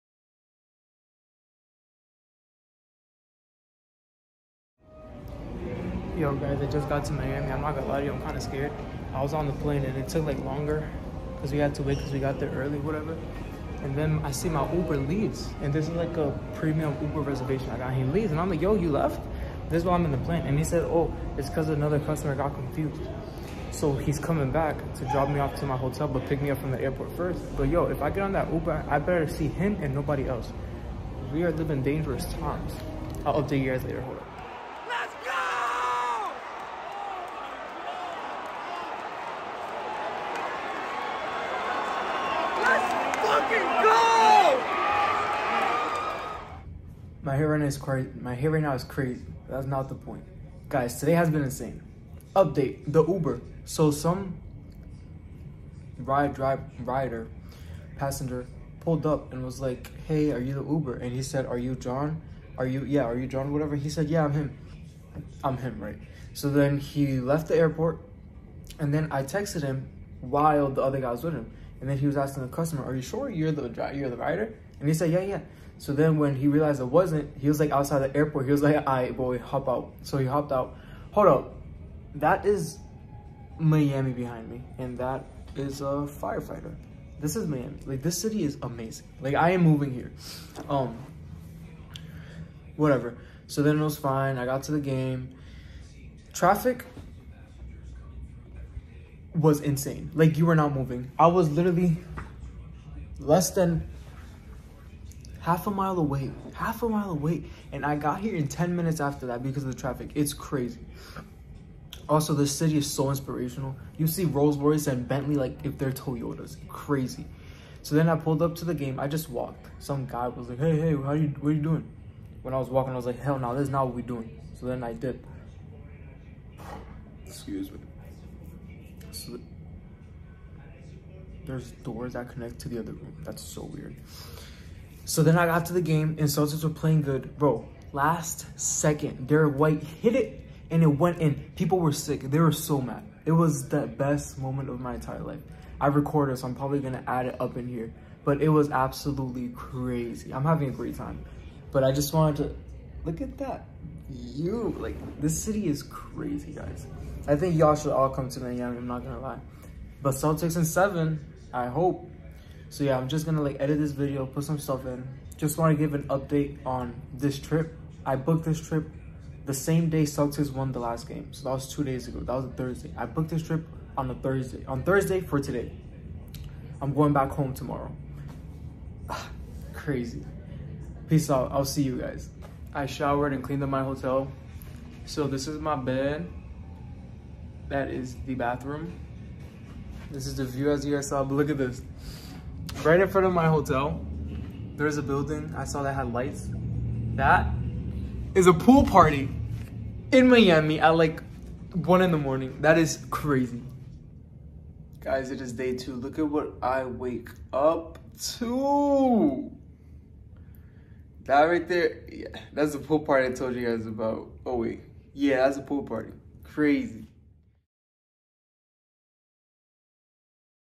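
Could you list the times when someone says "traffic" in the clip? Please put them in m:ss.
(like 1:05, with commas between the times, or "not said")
1:36, 1:49.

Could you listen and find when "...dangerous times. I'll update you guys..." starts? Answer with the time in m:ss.
0:31.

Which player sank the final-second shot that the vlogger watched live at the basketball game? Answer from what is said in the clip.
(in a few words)
Derrick White.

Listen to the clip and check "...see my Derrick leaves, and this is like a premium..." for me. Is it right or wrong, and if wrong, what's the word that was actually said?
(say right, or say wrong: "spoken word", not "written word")
wrong: "Uber", not "Derrick".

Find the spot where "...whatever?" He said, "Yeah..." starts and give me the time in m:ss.
1:03.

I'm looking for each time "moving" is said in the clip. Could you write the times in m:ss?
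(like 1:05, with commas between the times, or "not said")
1:29, 1:40.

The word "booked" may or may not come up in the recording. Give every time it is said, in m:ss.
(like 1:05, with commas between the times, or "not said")
2:48, 2:53.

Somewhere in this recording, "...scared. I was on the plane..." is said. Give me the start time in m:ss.
0:08.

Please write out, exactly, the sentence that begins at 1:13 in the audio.
You're the rider?" And he said, "Yeah, yeah." So then when he realized it wasn't, he was like outside the airport.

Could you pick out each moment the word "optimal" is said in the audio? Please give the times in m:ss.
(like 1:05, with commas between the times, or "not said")
not said.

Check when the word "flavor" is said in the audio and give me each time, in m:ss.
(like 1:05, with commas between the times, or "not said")
not said.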